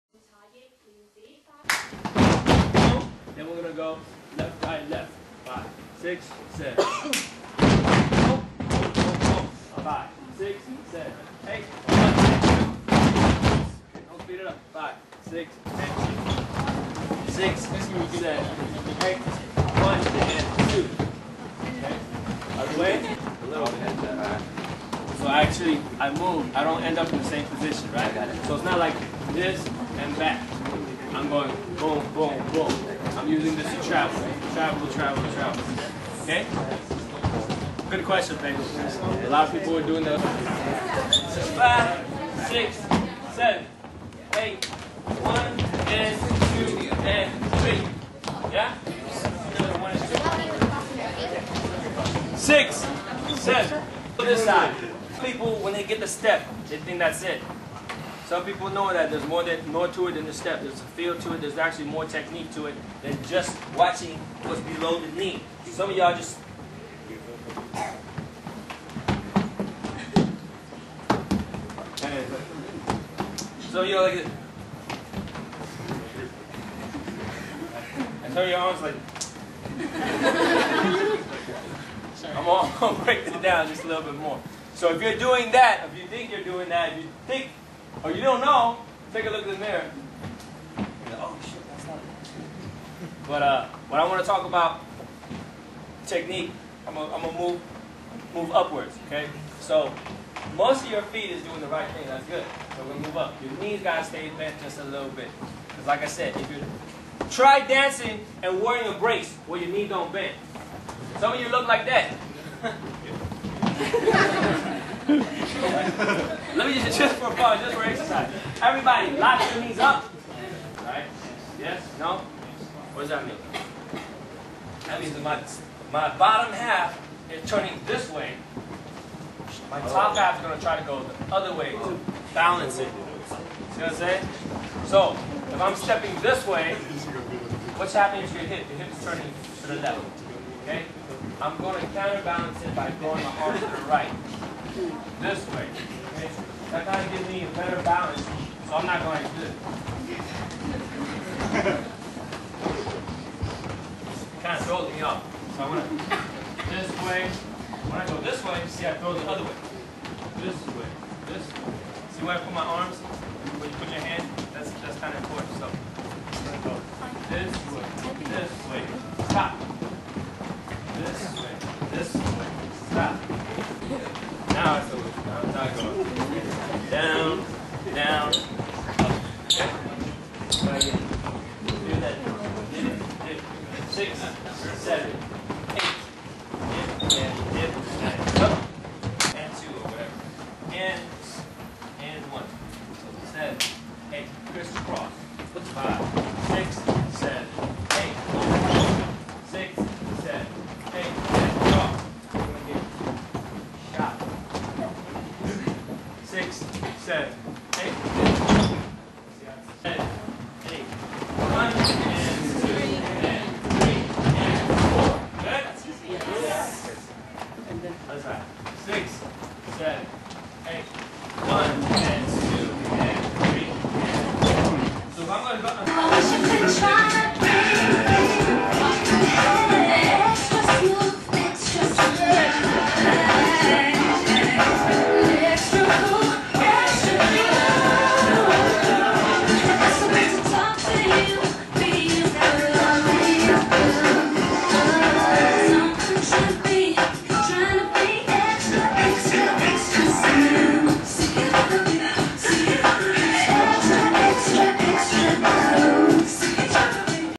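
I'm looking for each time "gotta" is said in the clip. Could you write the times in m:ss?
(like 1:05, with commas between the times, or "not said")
1:43.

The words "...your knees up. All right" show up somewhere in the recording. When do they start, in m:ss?
1:59.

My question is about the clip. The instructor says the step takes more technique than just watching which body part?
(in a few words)
below the knee.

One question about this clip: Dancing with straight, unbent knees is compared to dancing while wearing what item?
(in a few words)
a brace.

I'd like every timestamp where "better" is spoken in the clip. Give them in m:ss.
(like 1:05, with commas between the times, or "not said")
2:27.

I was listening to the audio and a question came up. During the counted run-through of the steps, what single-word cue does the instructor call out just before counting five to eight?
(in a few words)
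Crisscross.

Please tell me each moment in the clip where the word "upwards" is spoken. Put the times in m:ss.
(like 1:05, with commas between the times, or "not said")
1:38.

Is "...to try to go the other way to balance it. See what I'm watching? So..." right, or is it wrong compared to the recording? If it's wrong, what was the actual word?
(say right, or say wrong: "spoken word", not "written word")
wrong: "saying", not "watching".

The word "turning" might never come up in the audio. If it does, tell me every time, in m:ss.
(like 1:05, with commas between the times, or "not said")
2:07, 2:19.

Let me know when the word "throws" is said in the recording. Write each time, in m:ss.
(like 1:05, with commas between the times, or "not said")
2:34, 2:38.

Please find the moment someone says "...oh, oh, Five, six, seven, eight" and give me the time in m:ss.
0:08.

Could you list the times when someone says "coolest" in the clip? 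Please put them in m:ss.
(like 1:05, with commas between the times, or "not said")
not said.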